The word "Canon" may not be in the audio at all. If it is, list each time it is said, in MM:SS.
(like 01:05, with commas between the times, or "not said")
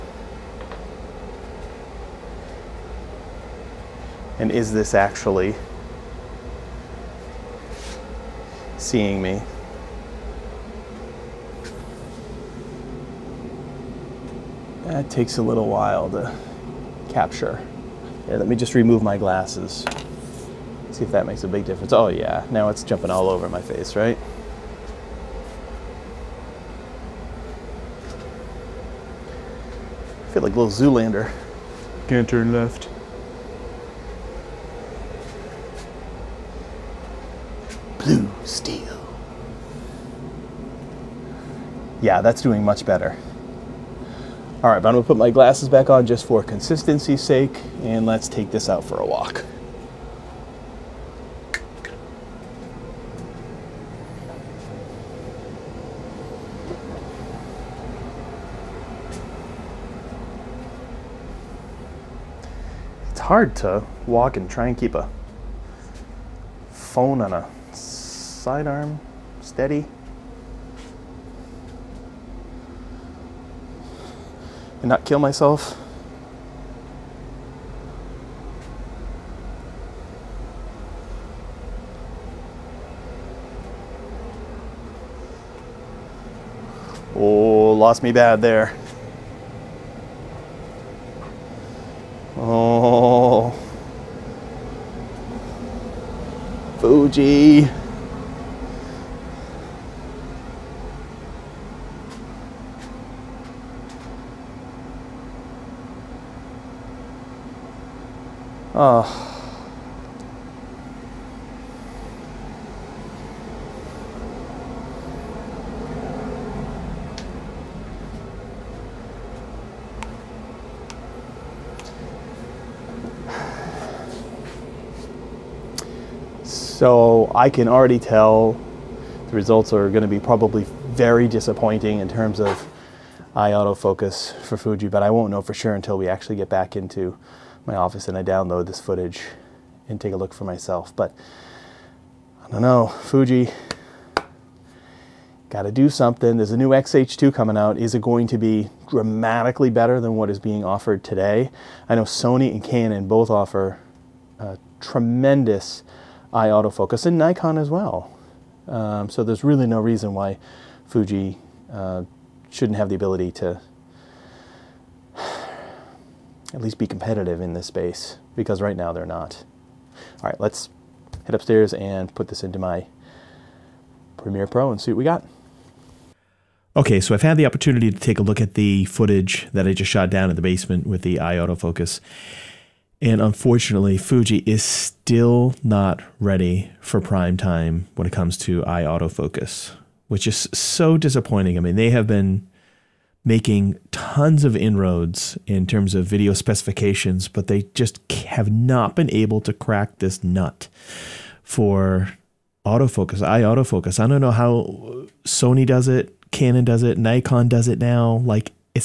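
02:32, 03:26.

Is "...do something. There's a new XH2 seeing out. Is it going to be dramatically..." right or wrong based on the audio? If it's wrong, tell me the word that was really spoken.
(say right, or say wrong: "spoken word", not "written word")
wrong: "coming", not "seeing".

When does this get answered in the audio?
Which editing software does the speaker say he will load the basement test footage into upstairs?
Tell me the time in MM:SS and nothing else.
02:54.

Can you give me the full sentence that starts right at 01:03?
It's hard to walk and try and keep a phone on a sidearm steady.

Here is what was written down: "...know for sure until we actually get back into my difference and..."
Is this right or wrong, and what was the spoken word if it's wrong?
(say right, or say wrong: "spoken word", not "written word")
wrong: "office", not "difference".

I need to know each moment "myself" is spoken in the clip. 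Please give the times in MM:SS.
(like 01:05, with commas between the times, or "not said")
01:15, 02:20.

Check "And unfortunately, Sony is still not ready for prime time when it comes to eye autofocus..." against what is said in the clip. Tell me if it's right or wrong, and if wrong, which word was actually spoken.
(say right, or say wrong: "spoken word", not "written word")
wrong: "Fuji", not "Sony".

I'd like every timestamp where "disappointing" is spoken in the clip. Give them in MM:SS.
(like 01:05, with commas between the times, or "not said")
02:11, 03:10.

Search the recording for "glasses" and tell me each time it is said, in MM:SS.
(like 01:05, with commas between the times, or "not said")
00:19, 00:45.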